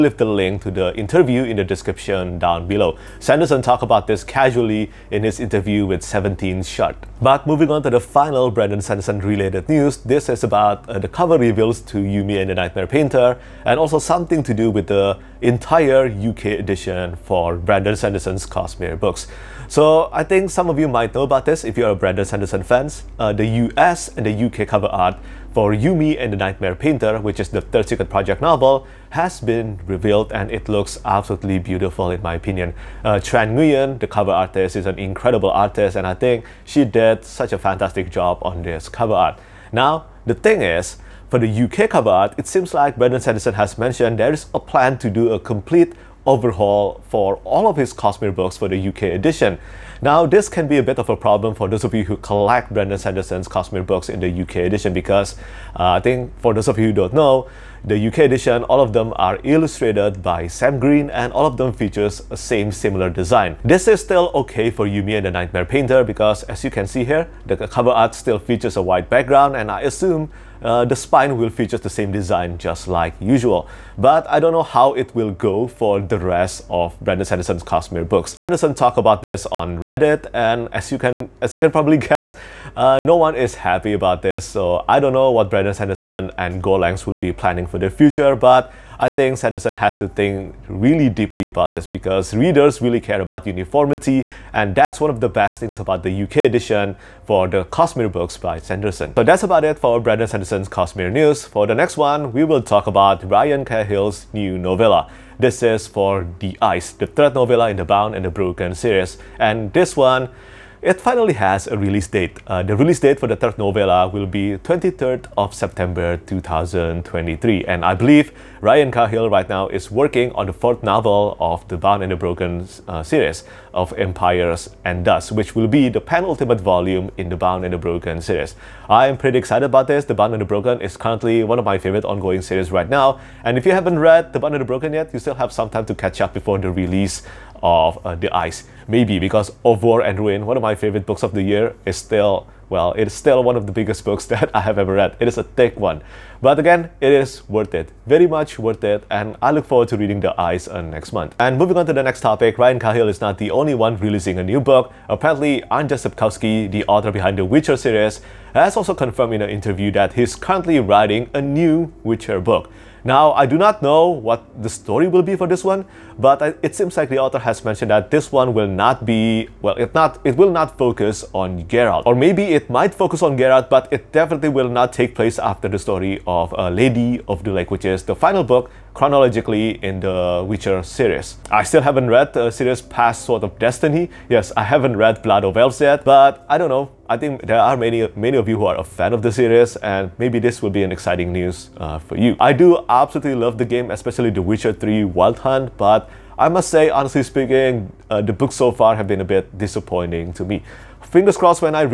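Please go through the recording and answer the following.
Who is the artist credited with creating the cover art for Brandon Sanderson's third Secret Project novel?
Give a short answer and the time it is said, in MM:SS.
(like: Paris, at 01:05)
Tran Nguyen, at 00:33.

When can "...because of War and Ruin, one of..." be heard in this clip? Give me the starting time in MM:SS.
02:19.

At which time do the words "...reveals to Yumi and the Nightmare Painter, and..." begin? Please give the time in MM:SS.
00:11.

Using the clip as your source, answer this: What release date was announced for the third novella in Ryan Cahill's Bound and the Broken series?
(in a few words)
23 September 2023.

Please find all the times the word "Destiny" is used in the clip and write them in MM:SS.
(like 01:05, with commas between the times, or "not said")
03:03.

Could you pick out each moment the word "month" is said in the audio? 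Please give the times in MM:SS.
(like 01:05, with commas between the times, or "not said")
02:31.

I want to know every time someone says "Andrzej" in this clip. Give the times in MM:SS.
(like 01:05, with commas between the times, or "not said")
02:35.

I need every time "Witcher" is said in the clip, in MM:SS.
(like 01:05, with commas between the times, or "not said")
02:37, 02:42, 03:00, 03:14.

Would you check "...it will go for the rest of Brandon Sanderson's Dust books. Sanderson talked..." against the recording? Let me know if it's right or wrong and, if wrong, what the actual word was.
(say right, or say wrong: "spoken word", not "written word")
wrong: "Cosmere", not "Dust".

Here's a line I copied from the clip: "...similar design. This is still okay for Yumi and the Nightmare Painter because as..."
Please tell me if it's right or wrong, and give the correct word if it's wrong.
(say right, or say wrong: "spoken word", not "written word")
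right.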